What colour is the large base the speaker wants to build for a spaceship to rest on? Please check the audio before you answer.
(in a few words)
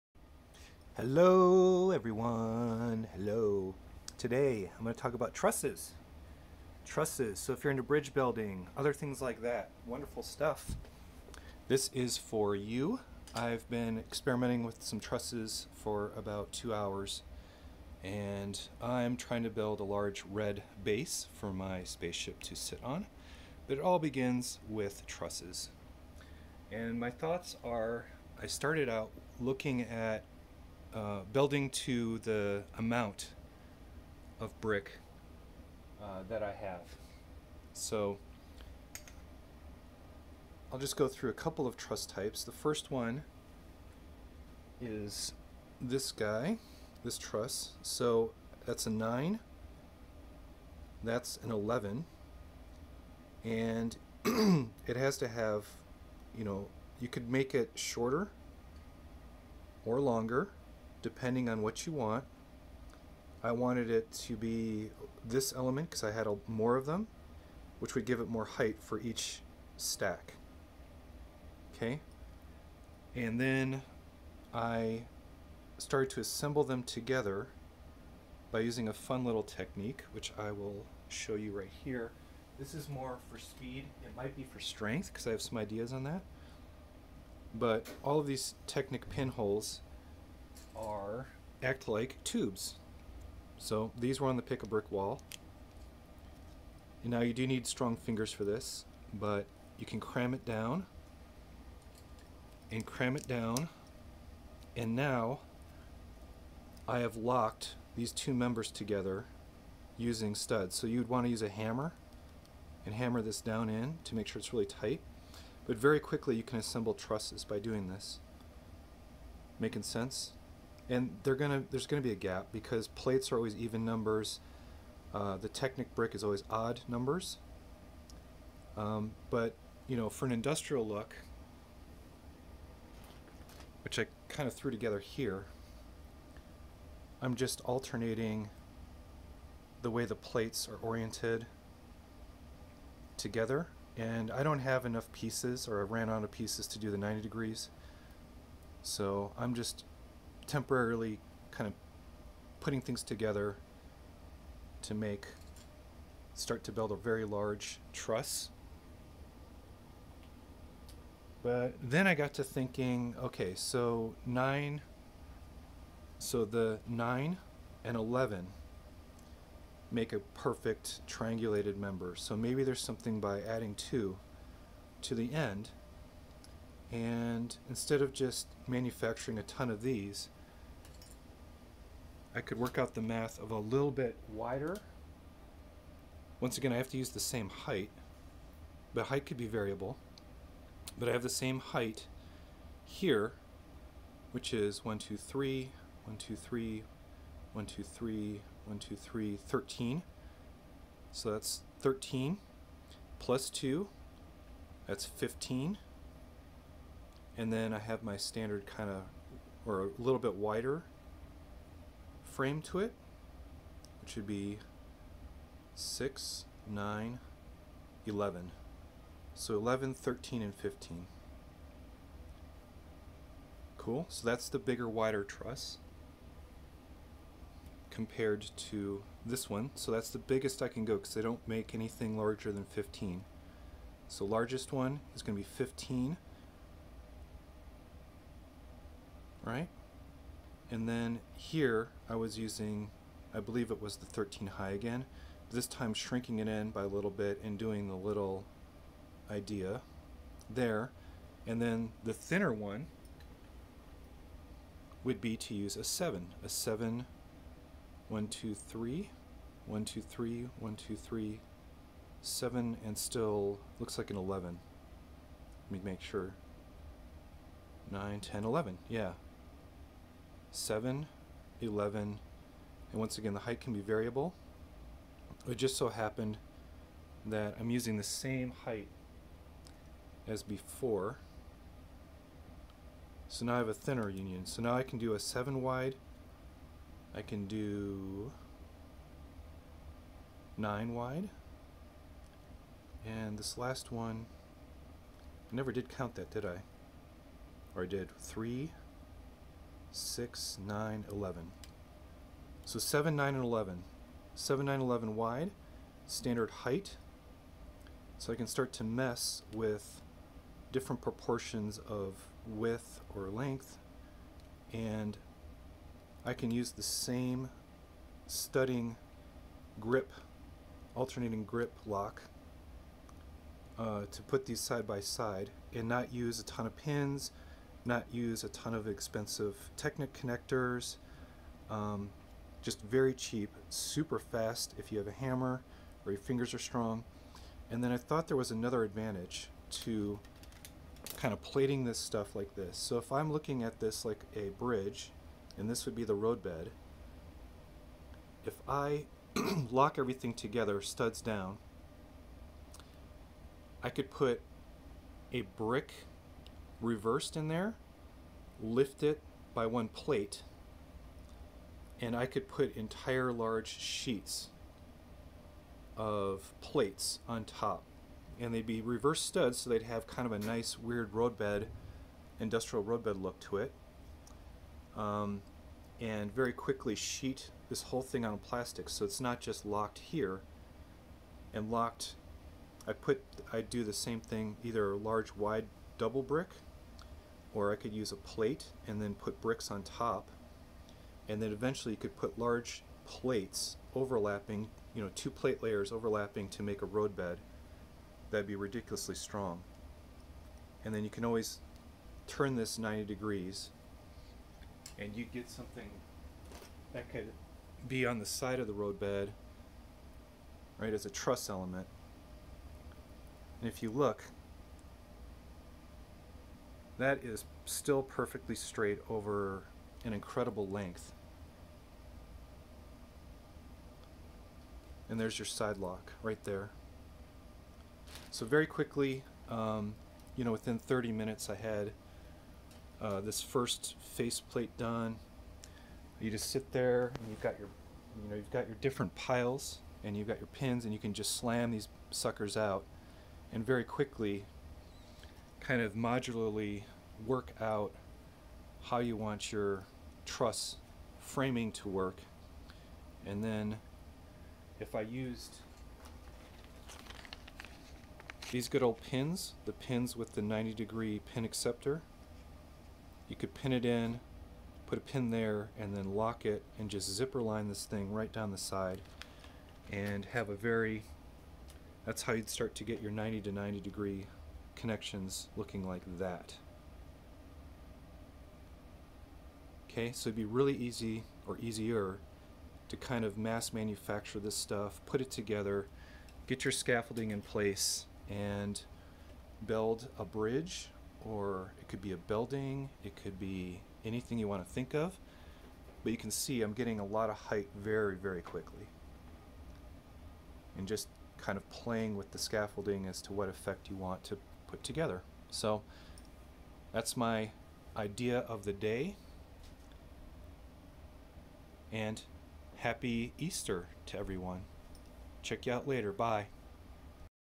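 Red.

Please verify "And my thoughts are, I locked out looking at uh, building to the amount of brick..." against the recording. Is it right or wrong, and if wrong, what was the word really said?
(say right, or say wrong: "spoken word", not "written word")
wrong: "started", not "locked".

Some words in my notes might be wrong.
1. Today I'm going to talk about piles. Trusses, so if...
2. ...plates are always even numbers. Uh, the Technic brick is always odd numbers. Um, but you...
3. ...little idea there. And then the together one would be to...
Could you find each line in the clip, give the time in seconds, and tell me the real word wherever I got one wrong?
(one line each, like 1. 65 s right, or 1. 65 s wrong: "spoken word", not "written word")
1. 4 s wrong: "trusses", not "piles"
2. 122 s right
3. 247 s wrong: "thinner", not "together".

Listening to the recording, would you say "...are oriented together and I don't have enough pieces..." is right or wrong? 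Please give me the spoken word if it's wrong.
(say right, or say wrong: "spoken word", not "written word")
right.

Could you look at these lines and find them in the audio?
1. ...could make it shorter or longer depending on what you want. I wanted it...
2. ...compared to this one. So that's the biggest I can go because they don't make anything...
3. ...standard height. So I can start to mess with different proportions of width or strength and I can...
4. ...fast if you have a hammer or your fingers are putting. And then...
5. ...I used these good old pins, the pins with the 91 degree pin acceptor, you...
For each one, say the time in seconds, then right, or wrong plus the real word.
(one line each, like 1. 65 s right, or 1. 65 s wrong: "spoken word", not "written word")
1. 57 s right
2. 227 s right
3. 306 s wrong: "length", not "strength"
4. 334 s wrong: "strong", not "putting"
5. 454 s wrong: "90", not "91".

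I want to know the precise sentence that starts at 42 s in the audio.
The first one is this guy, this truss.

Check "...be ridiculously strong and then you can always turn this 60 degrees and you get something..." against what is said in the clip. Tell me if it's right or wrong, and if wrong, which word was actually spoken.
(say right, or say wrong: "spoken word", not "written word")
wrong: "90", not "60".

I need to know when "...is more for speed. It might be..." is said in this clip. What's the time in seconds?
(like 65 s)
82 s.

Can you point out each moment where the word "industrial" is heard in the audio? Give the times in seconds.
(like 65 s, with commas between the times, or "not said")
130 s, 372 s.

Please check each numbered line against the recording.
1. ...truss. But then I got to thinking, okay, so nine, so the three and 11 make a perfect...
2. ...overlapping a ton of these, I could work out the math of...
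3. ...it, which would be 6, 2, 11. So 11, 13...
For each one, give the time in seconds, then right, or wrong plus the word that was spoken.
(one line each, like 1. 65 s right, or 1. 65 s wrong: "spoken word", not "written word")
1. 157 s wrong: "nine", not "three"
2. 178 s wrong: "manufacturing", not "overlapping"
3. 212 s wrong: "9", not "2".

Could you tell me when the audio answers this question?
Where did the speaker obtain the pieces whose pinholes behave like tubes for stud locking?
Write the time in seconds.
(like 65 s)
94 s.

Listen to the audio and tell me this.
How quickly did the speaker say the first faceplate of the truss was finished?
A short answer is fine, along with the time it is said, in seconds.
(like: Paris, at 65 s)
Within 30 minutes, at 430 s.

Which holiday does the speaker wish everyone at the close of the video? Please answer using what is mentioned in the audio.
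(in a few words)
Easter.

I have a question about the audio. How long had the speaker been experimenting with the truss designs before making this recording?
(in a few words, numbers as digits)
2 hours.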